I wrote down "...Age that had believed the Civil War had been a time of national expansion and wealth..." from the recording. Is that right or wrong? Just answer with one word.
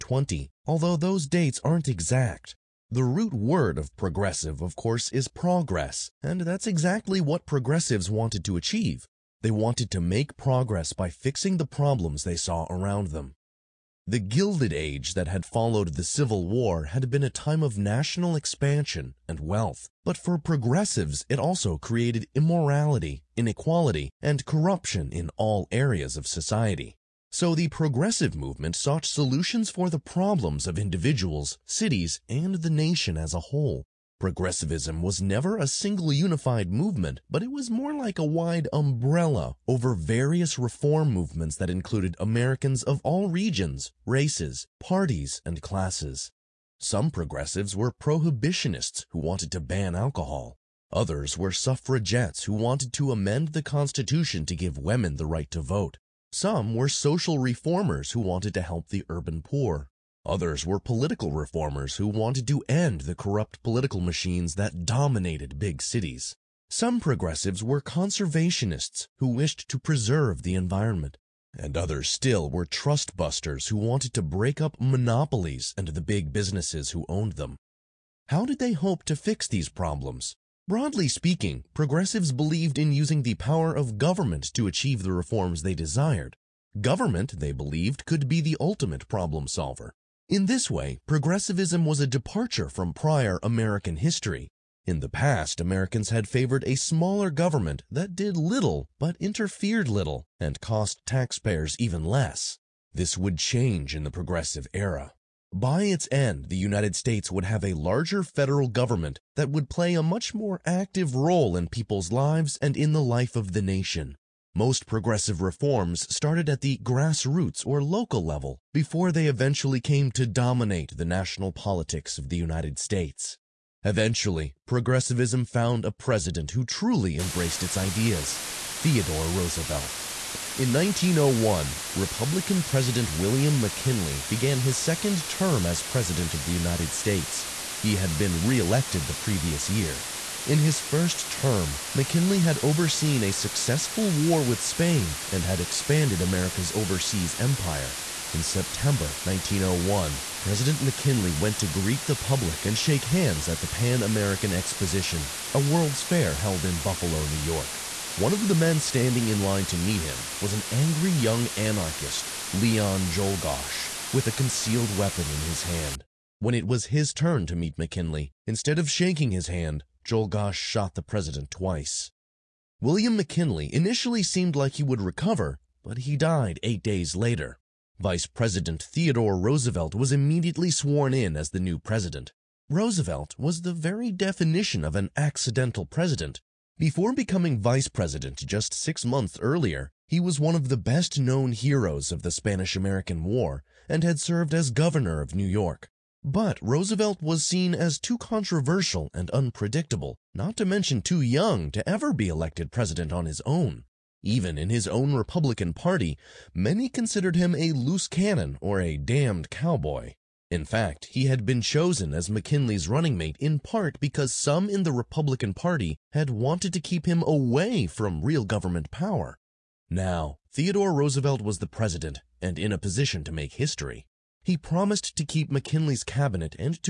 wrong.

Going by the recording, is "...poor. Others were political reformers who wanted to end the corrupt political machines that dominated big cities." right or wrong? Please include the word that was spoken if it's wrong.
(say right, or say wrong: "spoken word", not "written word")
right.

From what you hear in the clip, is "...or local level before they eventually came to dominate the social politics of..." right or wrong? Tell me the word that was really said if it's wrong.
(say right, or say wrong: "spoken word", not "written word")
wrong: "national", not "social".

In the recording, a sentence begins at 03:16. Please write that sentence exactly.
But Roosevelt was seen as too controversial and unpredictable, not to mention too young to ever be elected president on his own.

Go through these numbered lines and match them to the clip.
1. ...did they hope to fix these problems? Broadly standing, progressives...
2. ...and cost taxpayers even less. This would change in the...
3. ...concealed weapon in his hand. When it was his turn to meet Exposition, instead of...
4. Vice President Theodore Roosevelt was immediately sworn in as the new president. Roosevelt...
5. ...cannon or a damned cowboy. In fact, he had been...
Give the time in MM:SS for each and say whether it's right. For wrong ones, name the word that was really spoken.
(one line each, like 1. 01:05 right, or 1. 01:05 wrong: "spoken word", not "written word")
1. 01:18 wrong: "speaking", not "standing"
2. 01:40 right
3. 02:44 wrong: "McKinley", not "Exposition"
4. 02:57 right
5. 03:28 right.